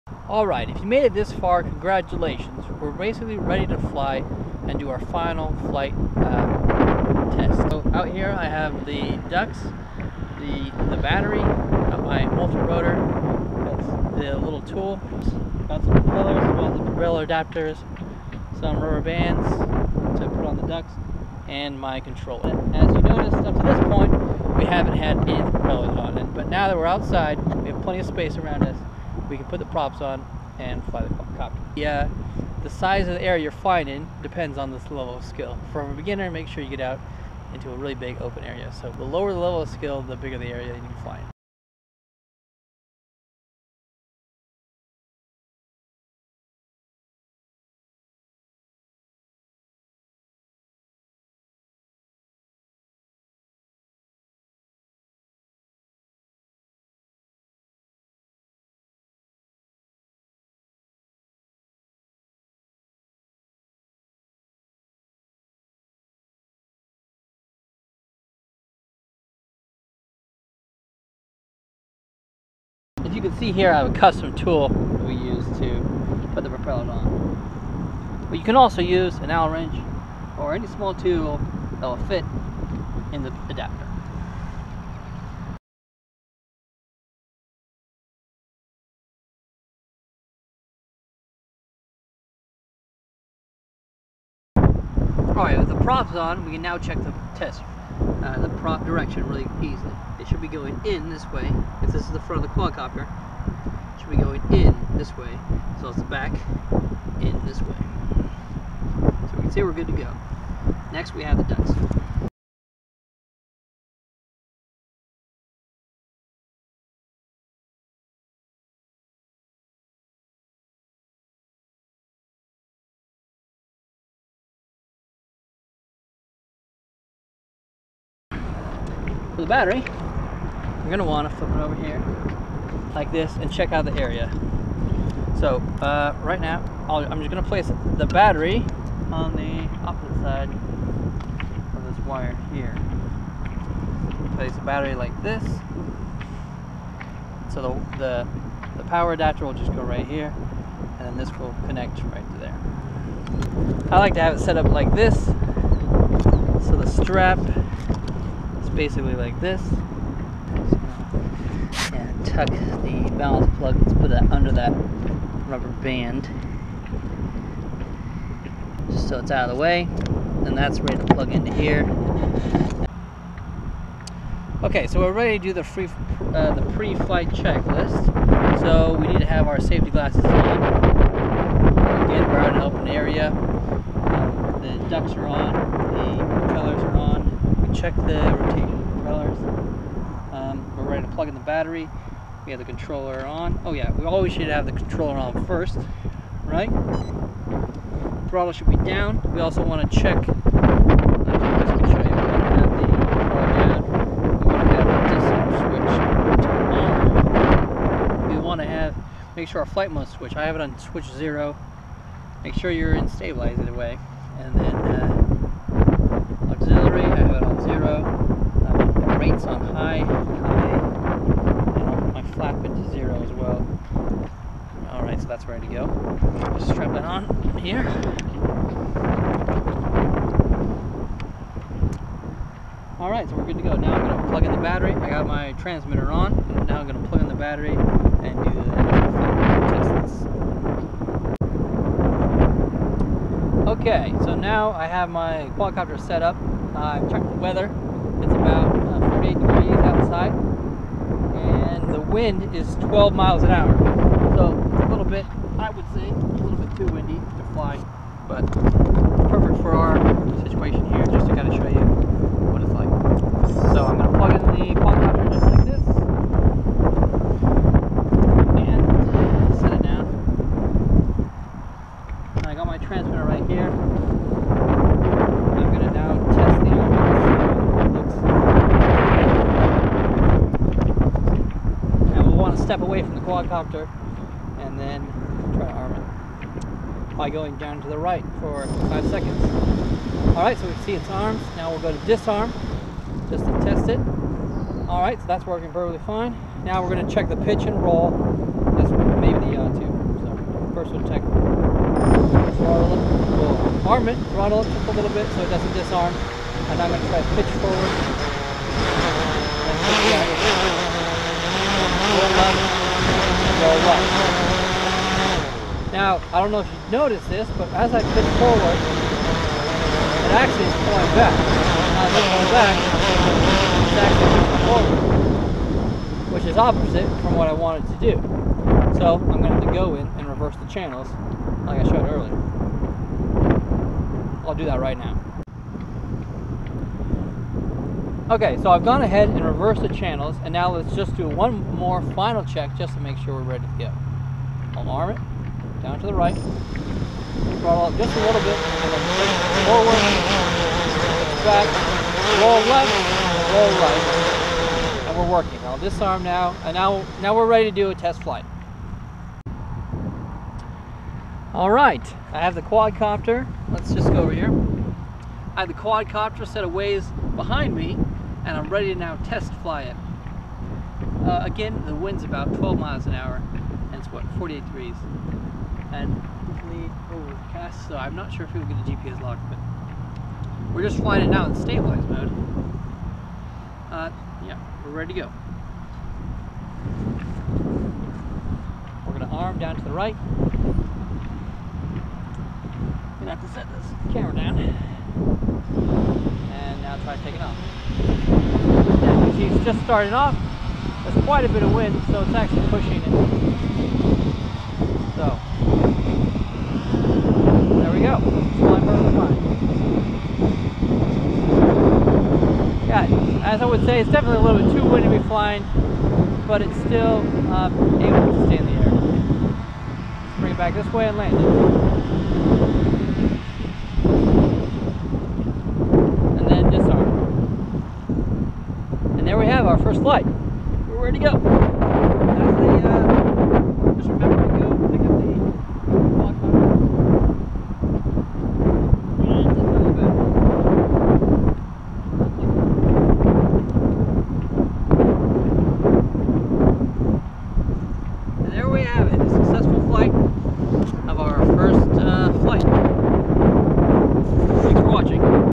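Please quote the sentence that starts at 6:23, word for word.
Uh, yeah, we're ready to go.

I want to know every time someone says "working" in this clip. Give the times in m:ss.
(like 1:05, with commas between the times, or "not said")
4:55, 5:55.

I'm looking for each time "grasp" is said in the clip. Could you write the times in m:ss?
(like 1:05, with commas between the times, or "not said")
not said.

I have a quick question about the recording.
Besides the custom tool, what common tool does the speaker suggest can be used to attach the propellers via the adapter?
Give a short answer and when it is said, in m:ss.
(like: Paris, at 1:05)
Allen wrench, at 1:19.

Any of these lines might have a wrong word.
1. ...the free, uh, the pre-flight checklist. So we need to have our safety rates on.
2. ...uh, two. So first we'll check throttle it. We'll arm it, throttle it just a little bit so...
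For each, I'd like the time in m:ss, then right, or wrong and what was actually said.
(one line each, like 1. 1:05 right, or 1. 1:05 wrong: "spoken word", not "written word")
1. 2:55 wrong: "glasses", not "rates"
2. 4:59 right.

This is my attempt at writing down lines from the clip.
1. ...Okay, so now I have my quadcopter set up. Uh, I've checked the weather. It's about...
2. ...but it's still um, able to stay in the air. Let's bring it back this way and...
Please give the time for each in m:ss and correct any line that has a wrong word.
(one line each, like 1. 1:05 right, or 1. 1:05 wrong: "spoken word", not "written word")
1. 4:03 right
2. 6:56 right.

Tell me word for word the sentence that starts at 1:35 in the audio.
Alright, with the props on, we can now check the test uh, the prop direction really easily.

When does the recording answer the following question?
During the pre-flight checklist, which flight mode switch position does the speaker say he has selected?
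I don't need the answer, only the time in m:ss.
3:30.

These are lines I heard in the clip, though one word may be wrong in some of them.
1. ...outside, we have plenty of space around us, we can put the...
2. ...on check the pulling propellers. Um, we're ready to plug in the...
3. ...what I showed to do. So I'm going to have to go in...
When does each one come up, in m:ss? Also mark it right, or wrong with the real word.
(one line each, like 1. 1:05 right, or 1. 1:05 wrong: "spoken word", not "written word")
1. 0:26 right
2. 3:05 wrong: "rotating", not "pulling"
3. 5:27 wrong: "wanted", not "showed".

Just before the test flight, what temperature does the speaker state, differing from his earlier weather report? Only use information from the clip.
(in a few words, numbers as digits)
48 degrees.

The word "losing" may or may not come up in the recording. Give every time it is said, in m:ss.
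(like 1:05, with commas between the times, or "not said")
not said.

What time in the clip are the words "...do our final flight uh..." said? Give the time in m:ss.
0:04.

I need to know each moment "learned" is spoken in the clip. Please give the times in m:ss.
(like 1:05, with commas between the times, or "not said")
not said.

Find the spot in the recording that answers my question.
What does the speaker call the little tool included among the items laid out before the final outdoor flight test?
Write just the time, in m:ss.
0:12.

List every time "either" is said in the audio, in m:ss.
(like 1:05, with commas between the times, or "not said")
3:33.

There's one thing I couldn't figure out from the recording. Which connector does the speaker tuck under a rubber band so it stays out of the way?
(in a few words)
balance plug.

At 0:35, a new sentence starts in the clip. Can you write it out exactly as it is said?
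From a beginner, make sure you get out into a really big open area.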